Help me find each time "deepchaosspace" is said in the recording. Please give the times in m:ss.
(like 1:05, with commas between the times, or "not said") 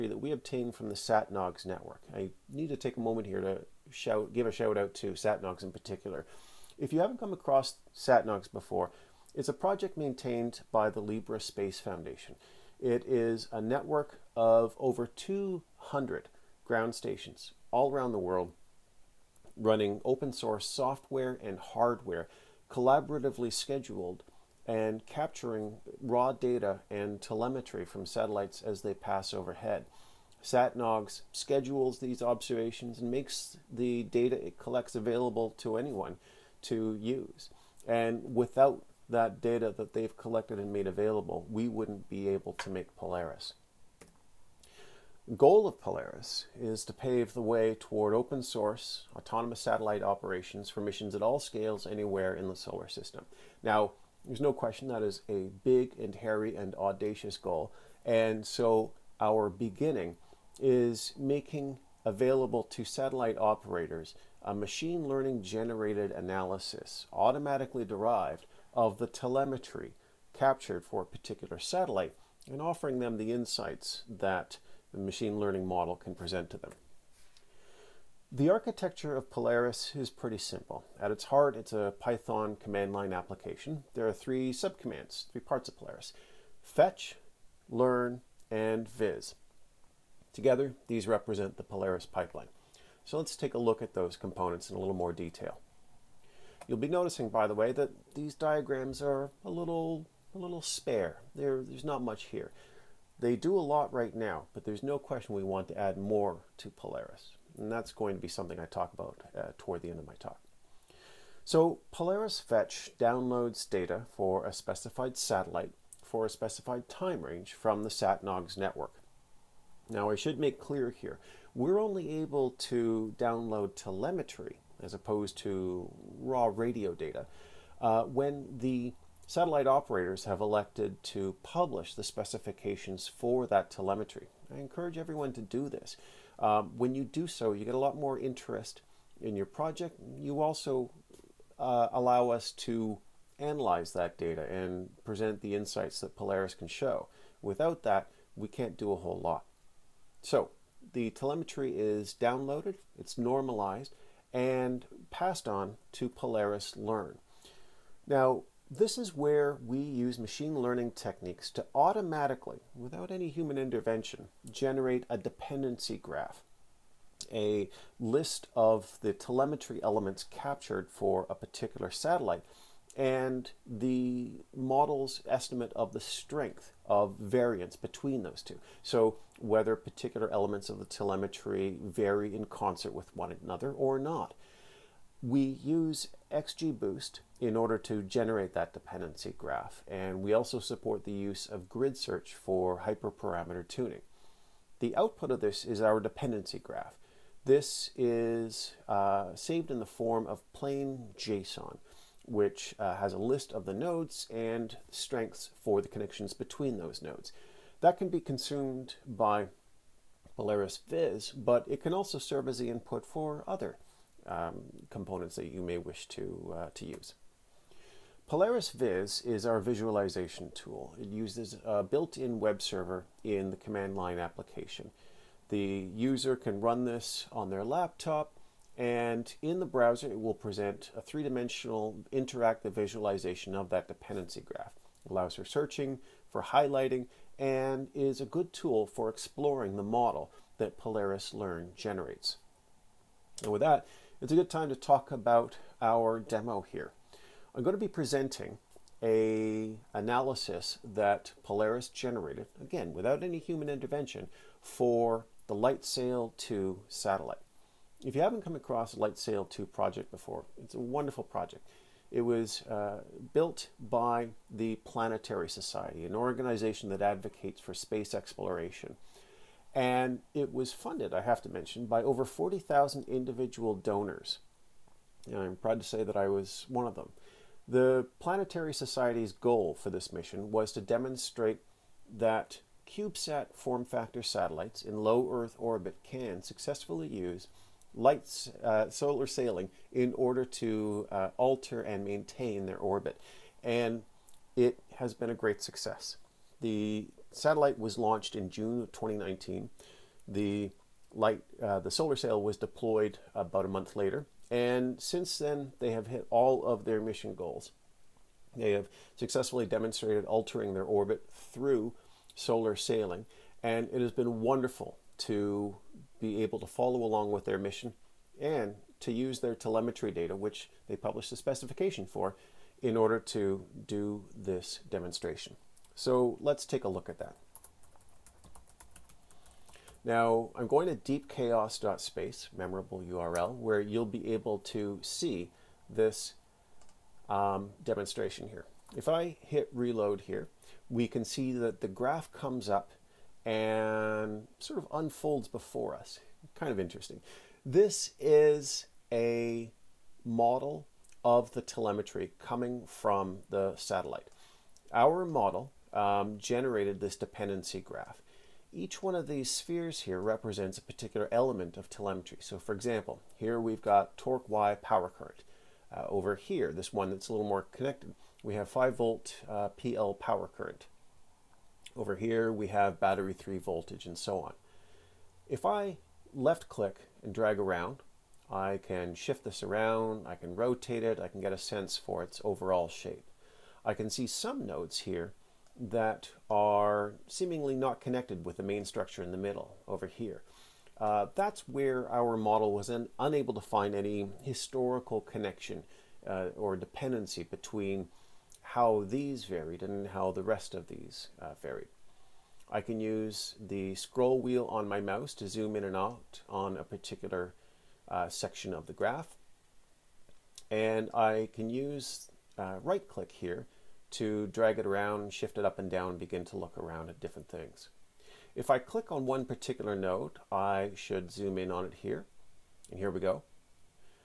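5:31.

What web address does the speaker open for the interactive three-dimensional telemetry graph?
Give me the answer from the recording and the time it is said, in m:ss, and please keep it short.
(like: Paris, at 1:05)
deepchaos.space, at 5:31.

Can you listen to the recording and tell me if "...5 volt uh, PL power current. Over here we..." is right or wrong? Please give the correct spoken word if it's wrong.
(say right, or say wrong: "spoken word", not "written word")
right.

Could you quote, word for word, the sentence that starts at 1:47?
And that's going to be something I talk about uh, toward the end of my talk.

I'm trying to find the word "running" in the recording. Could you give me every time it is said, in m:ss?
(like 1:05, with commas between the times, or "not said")
0:19.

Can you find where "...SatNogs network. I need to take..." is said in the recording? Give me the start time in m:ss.
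0:00.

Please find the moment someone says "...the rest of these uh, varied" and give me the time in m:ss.
6:40.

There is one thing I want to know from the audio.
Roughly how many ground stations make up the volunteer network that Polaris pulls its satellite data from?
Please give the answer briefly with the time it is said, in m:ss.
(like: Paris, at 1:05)
over 200, at 0:14.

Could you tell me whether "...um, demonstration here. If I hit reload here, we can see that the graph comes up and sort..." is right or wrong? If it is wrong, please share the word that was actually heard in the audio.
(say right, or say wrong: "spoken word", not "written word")
right.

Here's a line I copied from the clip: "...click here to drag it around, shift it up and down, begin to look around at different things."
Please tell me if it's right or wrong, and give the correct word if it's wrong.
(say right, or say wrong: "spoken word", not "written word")
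right.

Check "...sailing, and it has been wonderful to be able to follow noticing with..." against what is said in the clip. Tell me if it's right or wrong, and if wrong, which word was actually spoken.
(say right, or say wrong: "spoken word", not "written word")
wrong: "along", not "noticing".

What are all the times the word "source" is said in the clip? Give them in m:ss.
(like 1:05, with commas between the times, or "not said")
0:20, 0:48.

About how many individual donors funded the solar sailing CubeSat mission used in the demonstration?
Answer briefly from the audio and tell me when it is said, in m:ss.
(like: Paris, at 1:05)
over 40,000, at 4:32.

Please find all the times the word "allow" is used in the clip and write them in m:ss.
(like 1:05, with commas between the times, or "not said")
2:21, 3:55.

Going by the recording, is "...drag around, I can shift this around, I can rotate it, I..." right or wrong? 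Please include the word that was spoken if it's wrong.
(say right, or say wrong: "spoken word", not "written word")
right.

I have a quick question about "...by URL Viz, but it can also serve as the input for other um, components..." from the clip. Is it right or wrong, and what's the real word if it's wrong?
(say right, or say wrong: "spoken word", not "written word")
wrong: "Polaris", not "URL".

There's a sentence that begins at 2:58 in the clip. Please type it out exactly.
So whether particular elements of the telemetry vary in concert with one another or not.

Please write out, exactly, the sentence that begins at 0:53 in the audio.
Now, there's no question that is a big and hairy and audacious goal.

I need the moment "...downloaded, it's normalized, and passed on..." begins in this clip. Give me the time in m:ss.
2:32.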